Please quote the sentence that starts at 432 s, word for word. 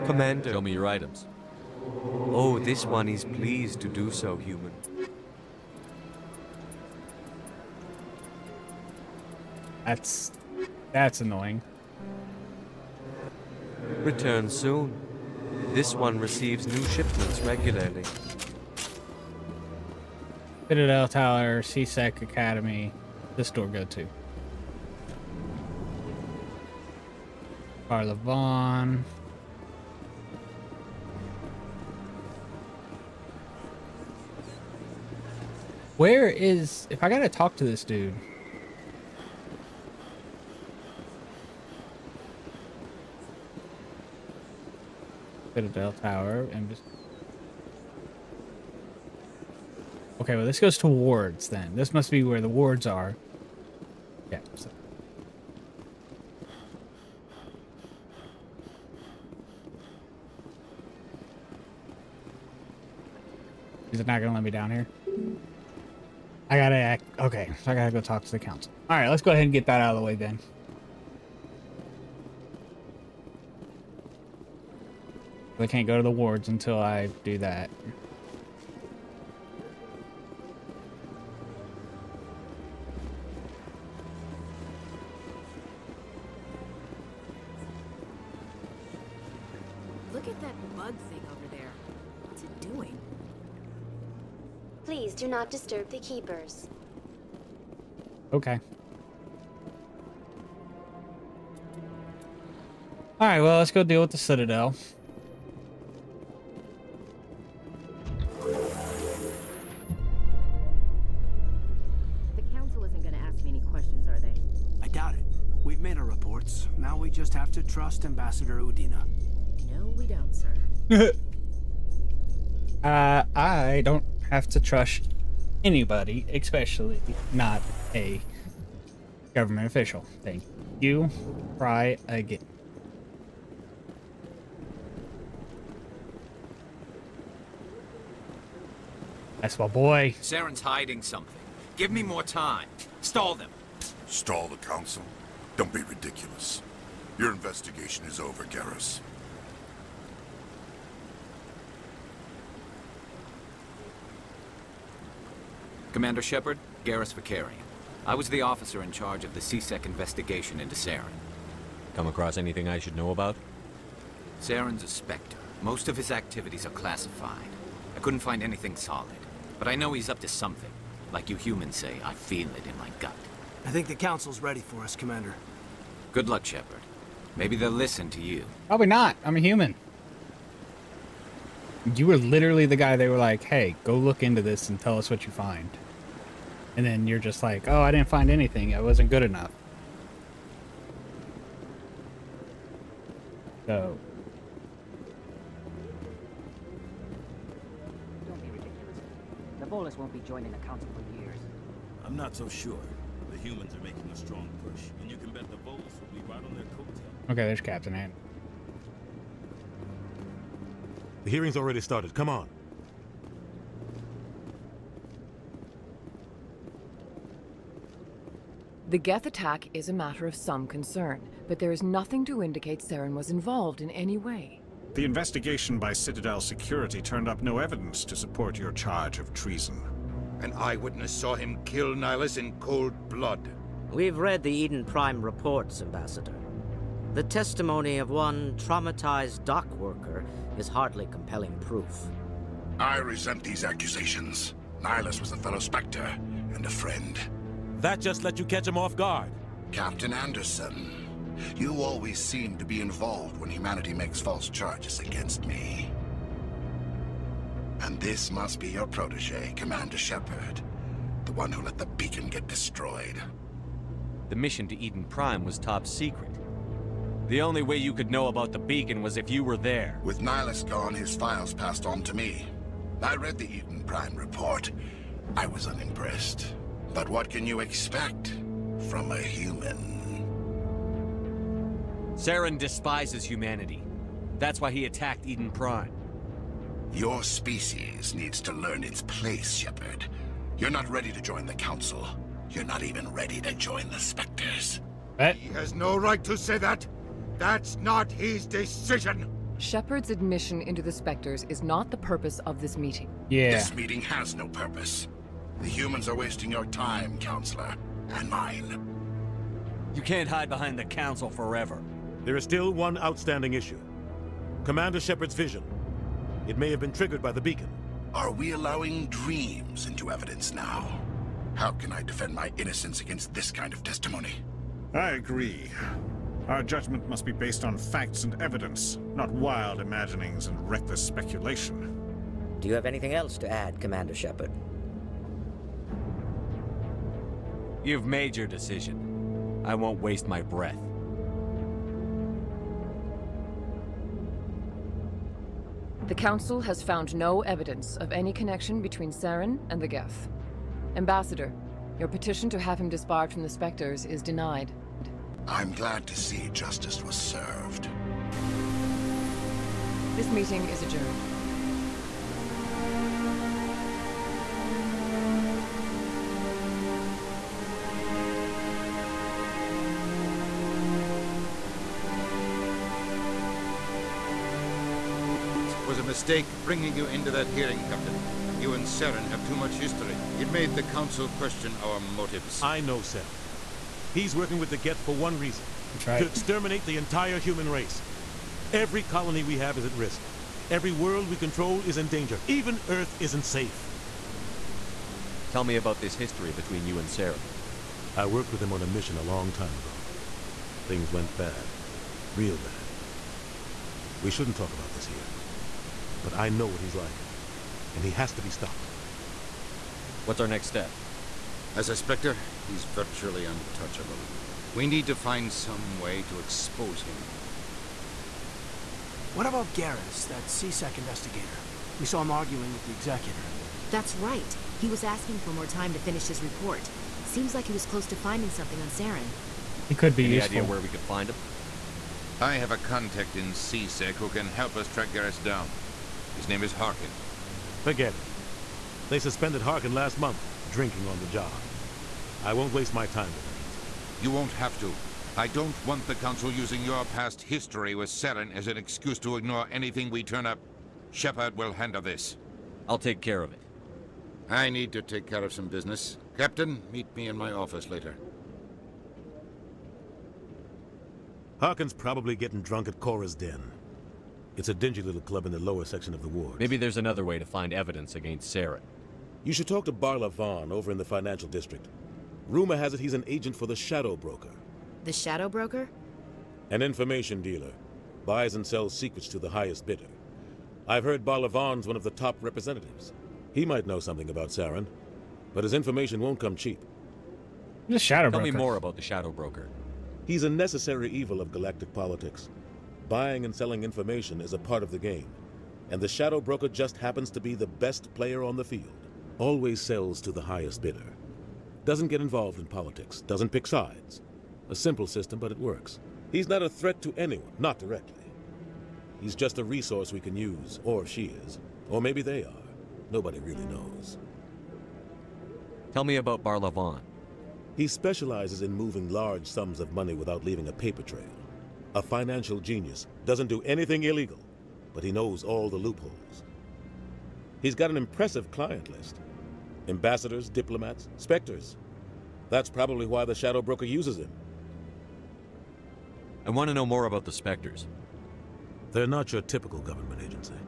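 I have a contact in C-Sec who can help us track Garrus down.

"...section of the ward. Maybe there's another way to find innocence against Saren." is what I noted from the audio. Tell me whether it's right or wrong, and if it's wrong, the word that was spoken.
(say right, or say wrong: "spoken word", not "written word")
wrong: "evidence", not "innocence".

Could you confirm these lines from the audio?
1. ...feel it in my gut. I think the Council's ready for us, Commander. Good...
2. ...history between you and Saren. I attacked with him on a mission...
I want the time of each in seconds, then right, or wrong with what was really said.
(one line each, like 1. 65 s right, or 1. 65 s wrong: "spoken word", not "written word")
1. 172 s right
2. 396 s wrong: "worked", not "attacked".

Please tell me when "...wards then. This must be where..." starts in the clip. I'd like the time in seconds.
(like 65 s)
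50 s.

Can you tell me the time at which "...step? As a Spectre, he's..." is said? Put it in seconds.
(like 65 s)
410 s.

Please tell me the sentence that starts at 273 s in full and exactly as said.
I read the Eden Prime report.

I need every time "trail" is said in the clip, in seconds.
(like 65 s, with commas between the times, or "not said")
521 s.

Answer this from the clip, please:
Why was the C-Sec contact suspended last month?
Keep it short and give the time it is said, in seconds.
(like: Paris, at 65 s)
Drinking on the job, at 440 s.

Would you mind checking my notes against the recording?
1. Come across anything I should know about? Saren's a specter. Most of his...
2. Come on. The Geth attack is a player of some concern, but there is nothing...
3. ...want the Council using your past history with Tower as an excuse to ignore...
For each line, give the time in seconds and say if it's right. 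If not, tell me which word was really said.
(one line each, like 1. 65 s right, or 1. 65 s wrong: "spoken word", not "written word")
1. 161 s right
2. 212 s wrong: "matter", not "player"
3. 445 s wrong: "Saren", not "Tower".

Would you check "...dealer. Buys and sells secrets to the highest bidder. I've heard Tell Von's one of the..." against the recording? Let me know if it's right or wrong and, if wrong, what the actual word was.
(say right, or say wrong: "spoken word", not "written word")
wrong: "Barla", not "Tell".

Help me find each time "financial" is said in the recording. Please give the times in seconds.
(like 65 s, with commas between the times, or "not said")
471 s, 522 s.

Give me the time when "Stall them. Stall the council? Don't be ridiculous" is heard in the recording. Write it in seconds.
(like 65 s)
142 s.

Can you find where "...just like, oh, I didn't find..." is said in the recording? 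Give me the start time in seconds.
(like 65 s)
187 s.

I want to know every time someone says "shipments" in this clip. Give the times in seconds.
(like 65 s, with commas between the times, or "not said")
16 s.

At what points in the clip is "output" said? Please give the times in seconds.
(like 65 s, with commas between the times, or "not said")
not said.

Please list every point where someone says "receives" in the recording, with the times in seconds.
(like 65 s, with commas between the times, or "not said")
16 s.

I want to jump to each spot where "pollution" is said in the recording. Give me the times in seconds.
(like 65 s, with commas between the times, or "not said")
not said.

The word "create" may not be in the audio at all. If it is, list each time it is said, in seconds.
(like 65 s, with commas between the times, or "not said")
not said.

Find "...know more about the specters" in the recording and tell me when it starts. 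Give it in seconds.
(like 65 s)
536 s.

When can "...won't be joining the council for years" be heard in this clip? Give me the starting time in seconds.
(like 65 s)
199 s.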